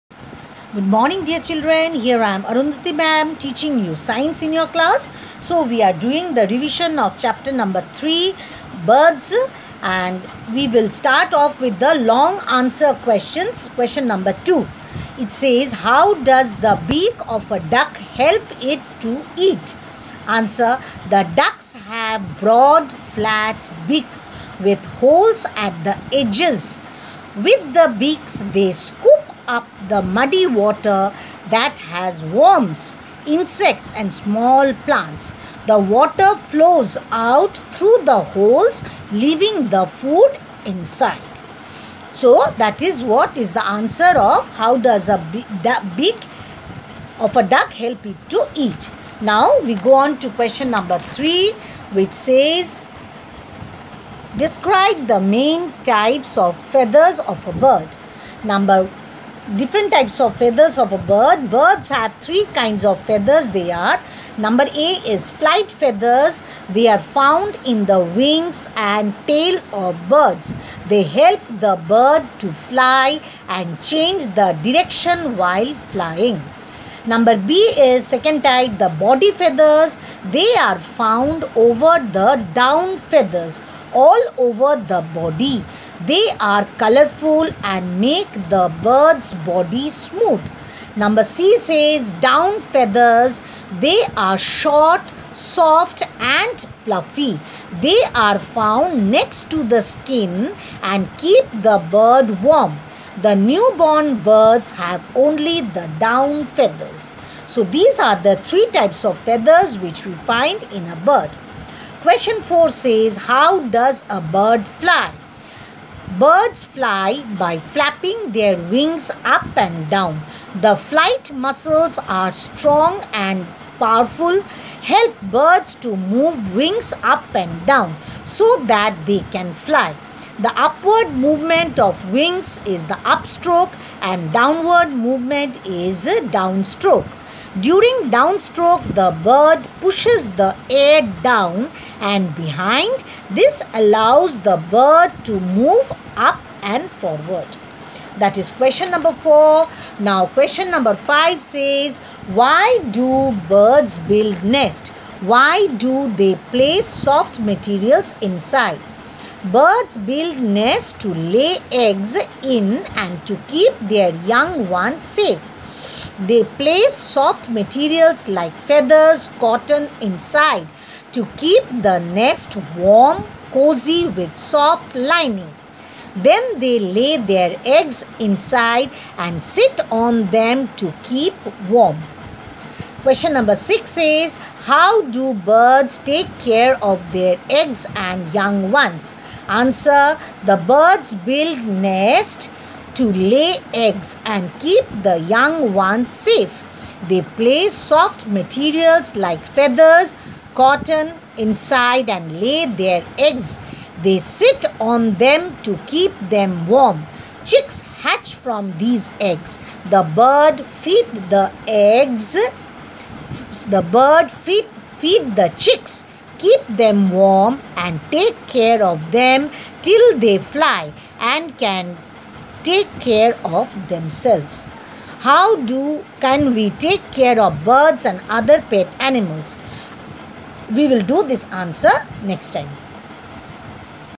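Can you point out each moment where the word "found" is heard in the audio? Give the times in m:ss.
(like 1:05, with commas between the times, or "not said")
1:06, 1:20, 1:38.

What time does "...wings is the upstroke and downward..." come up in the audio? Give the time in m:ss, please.
2:12.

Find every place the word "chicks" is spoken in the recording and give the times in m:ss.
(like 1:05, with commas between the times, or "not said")
3:27, 3:35.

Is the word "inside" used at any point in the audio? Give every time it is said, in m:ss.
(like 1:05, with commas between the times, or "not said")
0:40, 2:38, 2:49, 2:58, 3:21.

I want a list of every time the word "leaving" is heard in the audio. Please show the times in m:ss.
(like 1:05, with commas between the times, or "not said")
0:39.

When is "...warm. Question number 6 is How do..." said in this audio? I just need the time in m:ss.
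3:01.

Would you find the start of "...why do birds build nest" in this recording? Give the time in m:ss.
2:32.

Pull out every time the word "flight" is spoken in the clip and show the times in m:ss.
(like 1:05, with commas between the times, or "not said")
1:05, 2:00.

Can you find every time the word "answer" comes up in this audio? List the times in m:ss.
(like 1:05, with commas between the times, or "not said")
0:12, 0:20, 0:43, 3:09, 3:51.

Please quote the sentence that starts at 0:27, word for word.
With the beaks they scoop up the muddy water that has worms, insects, and small plants.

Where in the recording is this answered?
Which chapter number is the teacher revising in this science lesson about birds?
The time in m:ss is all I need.
0:07.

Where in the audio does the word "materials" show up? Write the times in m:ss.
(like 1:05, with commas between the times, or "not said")
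2:37, 2:47, 3:18.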